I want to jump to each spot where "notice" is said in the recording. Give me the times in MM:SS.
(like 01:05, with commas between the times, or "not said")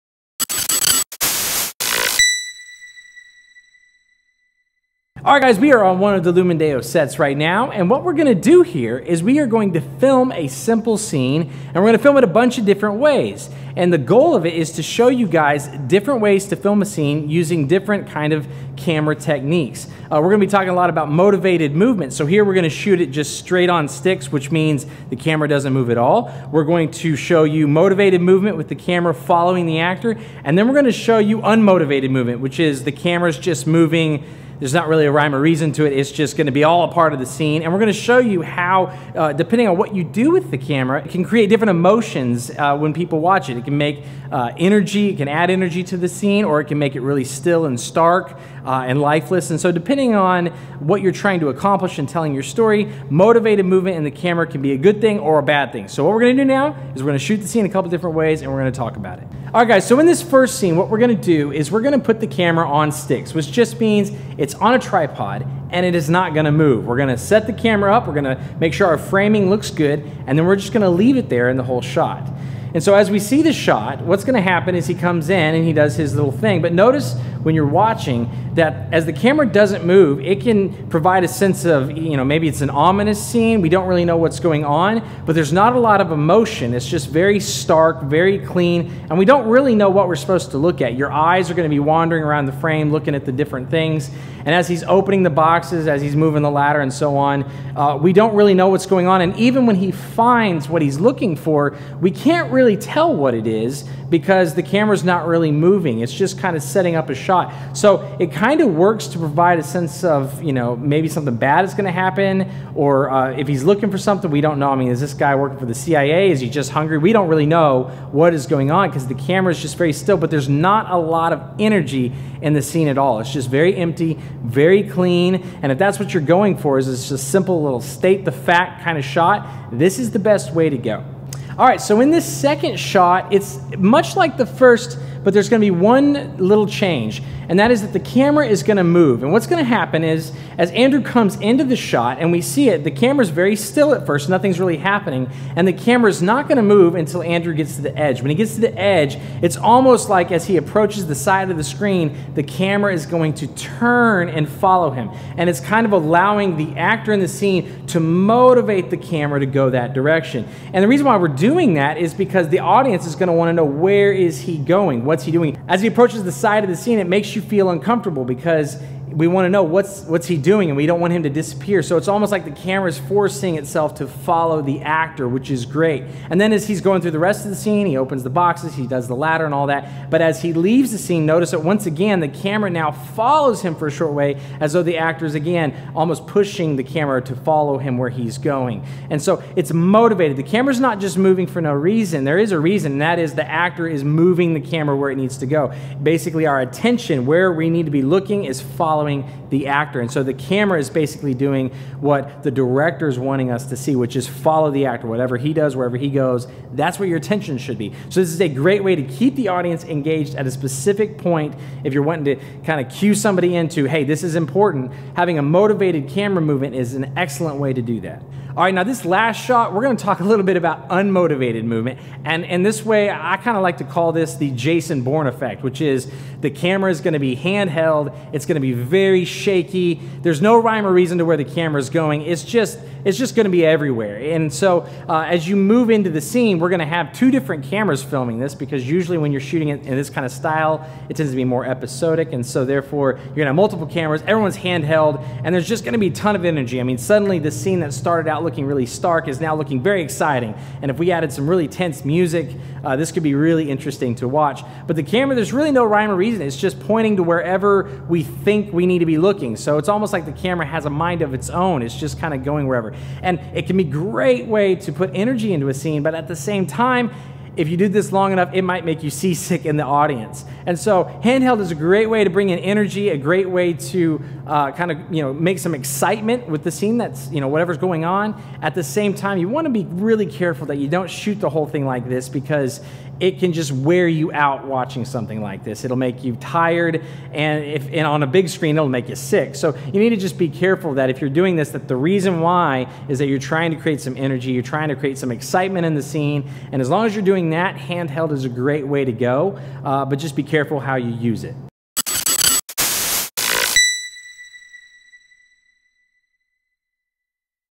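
01:16, 03:01.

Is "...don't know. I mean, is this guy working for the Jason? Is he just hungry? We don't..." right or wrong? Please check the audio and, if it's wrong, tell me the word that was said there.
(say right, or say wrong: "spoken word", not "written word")
wrong: "CIA", not "Jason".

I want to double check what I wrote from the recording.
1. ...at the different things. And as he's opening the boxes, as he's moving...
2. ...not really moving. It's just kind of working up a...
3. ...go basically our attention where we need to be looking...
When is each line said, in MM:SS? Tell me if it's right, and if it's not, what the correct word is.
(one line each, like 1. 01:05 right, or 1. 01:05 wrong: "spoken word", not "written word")
1. 01:33 right
2. 01:45 wrong: "setting", not "working"
3. 03:15 right.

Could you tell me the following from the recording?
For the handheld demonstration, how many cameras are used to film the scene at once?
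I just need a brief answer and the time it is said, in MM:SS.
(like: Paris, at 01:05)
2, at 03:57.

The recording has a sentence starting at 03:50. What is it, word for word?
There's no rhyme or reason to where the camera is going.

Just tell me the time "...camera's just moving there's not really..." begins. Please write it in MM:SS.
00:32.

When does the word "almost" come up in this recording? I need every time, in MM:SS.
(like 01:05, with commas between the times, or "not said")
02:29, 02:52, 03:05, 04:19.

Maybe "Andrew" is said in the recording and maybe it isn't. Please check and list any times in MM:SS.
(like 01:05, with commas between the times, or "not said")
02:20, 02:27.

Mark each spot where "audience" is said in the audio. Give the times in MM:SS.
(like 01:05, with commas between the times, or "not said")
02:42, 03:29, 04:29.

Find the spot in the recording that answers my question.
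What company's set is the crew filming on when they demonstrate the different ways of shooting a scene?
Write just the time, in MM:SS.
00:06.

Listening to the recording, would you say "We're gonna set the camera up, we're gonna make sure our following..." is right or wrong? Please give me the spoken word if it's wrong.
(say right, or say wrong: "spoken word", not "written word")
wrong: "framing", not "following".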